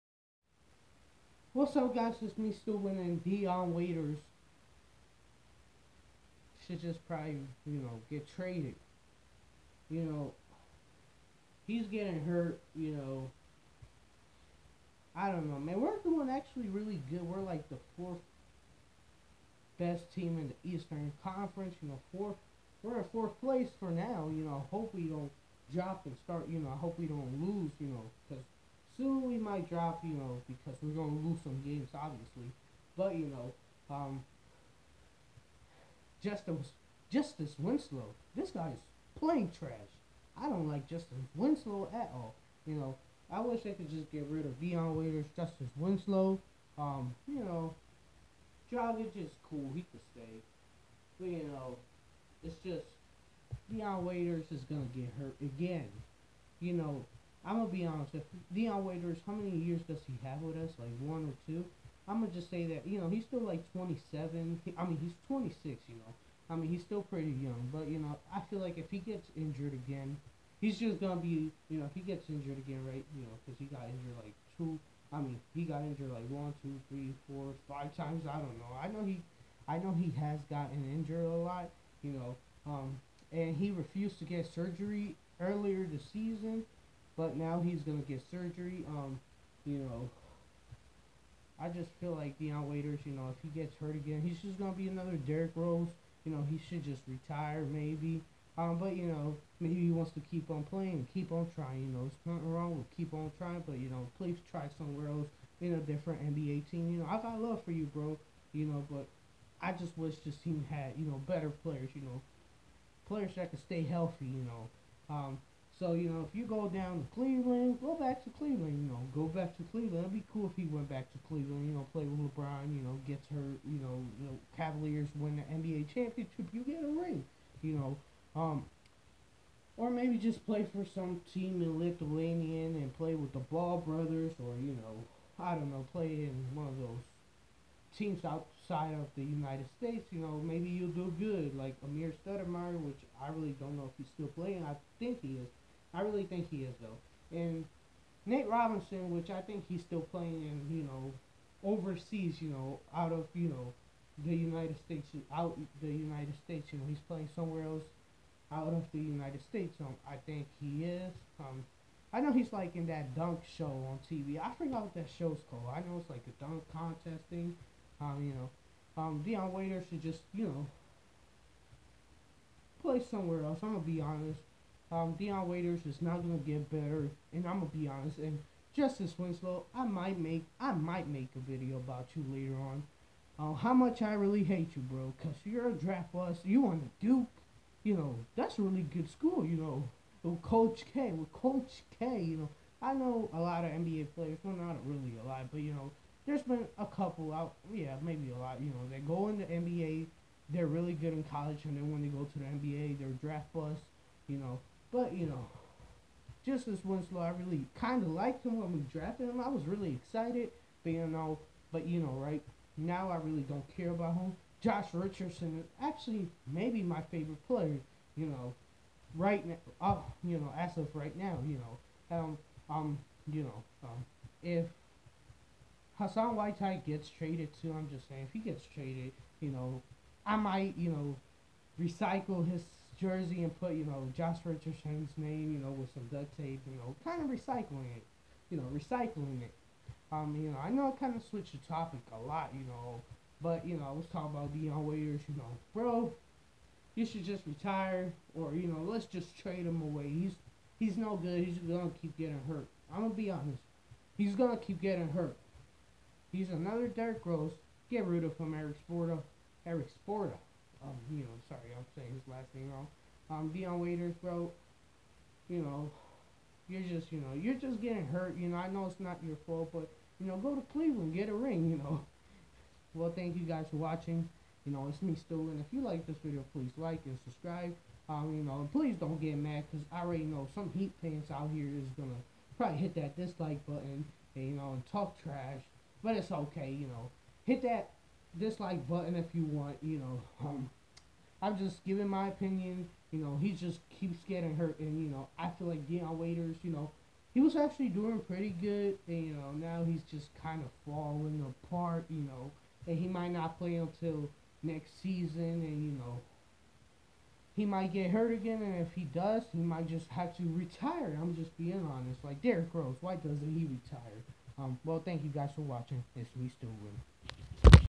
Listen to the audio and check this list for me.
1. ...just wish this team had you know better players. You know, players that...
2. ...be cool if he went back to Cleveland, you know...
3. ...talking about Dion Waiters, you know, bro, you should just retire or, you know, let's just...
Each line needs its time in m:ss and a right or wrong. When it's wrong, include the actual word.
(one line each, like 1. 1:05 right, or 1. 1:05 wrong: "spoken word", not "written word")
1. 1:49 right
2. 2:00 right
3. 4:04 right.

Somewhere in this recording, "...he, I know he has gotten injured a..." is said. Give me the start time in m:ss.
1:19.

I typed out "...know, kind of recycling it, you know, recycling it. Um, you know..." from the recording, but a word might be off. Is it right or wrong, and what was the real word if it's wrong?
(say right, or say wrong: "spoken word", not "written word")
right.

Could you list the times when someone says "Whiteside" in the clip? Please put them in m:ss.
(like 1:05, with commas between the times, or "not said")
3:46.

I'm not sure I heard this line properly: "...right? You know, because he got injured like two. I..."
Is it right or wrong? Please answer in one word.
right.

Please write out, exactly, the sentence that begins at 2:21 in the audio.
Like Amar'e Stoudemire, which I really don't know if he's still playing.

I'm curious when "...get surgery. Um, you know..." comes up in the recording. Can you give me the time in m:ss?
1:28.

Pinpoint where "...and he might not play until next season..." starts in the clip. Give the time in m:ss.
5:02.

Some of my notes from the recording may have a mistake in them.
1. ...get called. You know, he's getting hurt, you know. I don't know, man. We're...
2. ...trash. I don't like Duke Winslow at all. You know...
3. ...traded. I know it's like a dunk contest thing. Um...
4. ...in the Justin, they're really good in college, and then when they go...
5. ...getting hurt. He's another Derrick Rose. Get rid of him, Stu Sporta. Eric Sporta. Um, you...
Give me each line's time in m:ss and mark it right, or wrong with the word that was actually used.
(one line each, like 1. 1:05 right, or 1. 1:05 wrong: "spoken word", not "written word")
1. 0:08 wrong: "traded", not "called"
2. 0:39 wrong: "Justin", not "Duke"
3. 2:45 wrong: "called", not "traded"
4. 3:19 wrong: "NBA", not "Justin"
5. 4:14 wrong: "Eric", not "Stu".